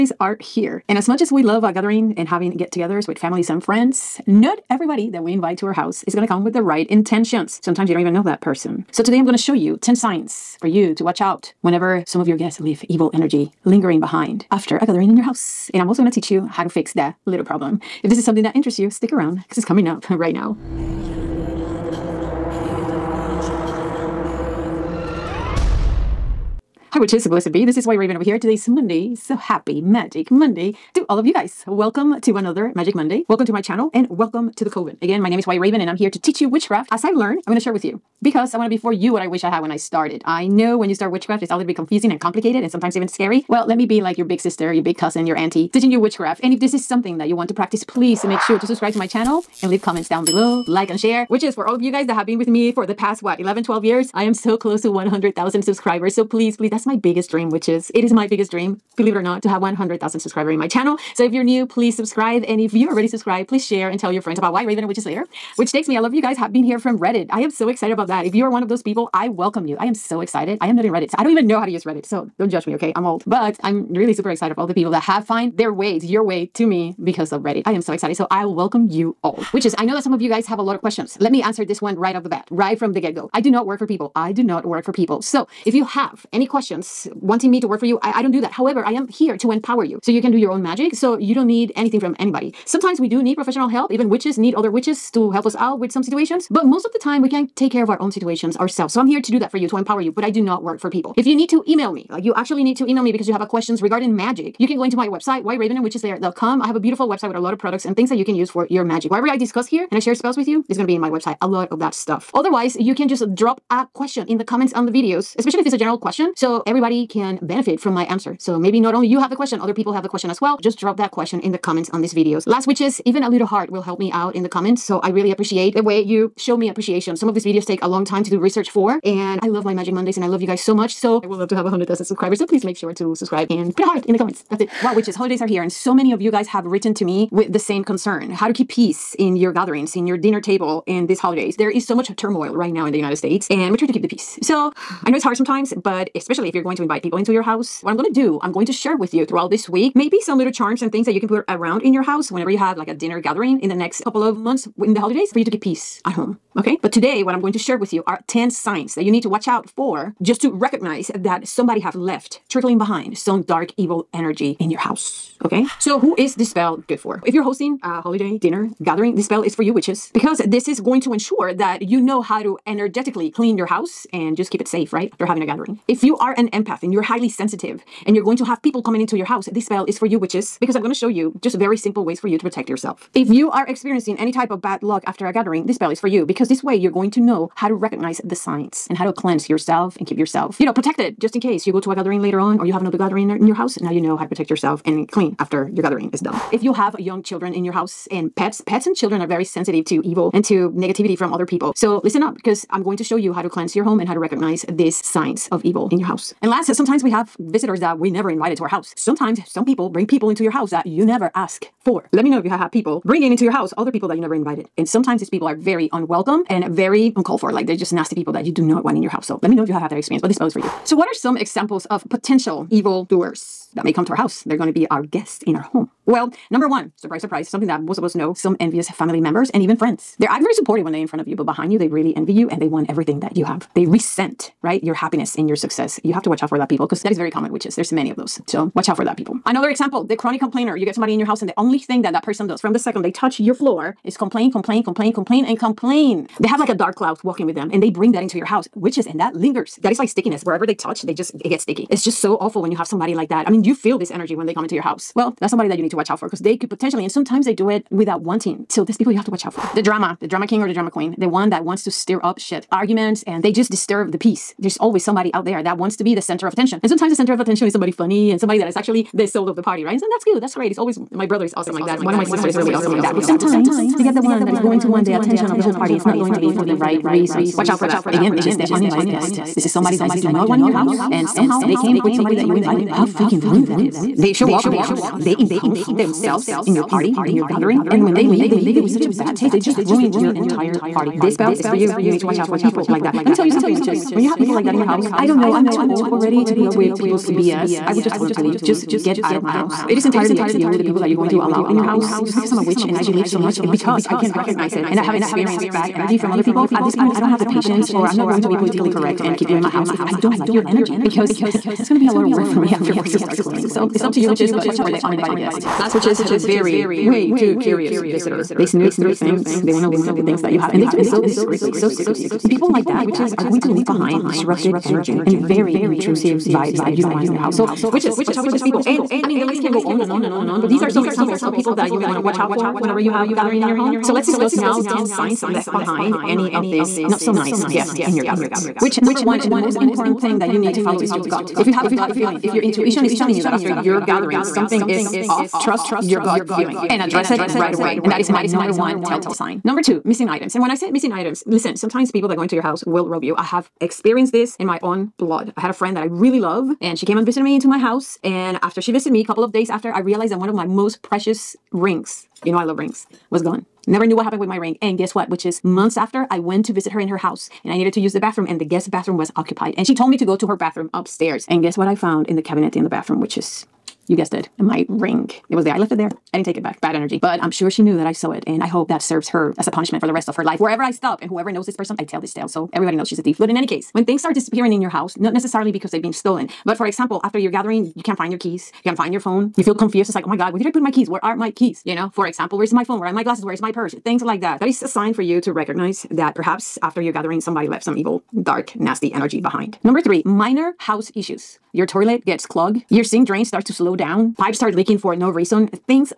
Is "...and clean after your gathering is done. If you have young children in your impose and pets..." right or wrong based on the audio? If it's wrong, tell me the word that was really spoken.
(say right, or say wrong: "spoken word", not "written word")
wrong: "house", not "impose".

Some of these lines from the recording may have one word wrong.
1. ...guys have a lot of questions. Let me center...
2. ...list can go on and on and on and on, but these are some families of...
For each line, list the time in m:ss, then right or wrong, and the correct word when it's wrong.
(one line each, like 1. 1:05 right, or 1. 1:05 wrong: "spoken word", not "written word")
1. 1:20 wrong: "answer", not "center"
2. 5:29 wrong: "examples", not "families".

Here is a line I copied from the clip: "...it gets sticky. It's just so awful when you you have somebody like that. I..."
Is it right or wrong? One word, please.
right.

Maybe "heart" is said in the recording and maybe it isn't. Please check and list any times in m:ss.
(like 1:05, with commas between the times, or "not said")
2:03, 2:13.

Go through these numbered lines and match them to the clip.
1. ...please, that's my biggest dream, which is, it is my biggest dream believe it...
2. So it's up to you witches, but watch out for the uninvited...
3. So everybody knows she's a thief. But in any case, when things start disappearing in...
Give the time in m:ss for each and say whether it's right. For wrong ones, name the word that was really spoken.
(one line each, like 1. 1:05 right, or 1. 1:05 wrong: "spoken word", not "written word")
1. 0:56 right
2. 5:13 right
3. 6:22 right.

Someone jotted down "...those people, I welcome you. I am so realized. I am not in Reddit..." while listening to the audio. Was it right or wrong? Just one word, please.
wrong.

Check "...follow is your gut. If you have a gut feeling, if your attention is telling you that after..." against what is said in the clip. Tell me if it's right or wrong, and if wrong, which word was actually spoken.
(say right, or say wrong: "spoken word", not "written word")
wrong: "intuition", not "attention".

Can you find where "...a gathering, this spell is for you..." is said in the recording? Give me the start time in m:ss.
3:05.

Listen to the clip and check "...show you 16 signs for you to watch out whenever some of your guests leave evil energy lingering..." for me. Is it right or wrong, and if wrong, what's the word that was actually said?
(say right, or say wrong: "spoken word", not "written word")
wrong: "10", not "16".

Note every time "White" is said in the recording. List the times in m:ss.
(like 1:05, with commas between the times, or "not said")
0:27, 0:35, 1:04.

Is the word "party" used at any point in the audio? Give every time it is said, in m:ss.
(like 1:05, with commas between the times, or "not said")
4:29, 4:35, 4:46, 4:50.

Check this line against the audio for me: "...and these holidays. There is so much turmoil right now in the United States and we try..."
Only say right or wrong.
right.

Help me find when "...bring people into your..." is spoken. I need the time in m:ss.
3:29.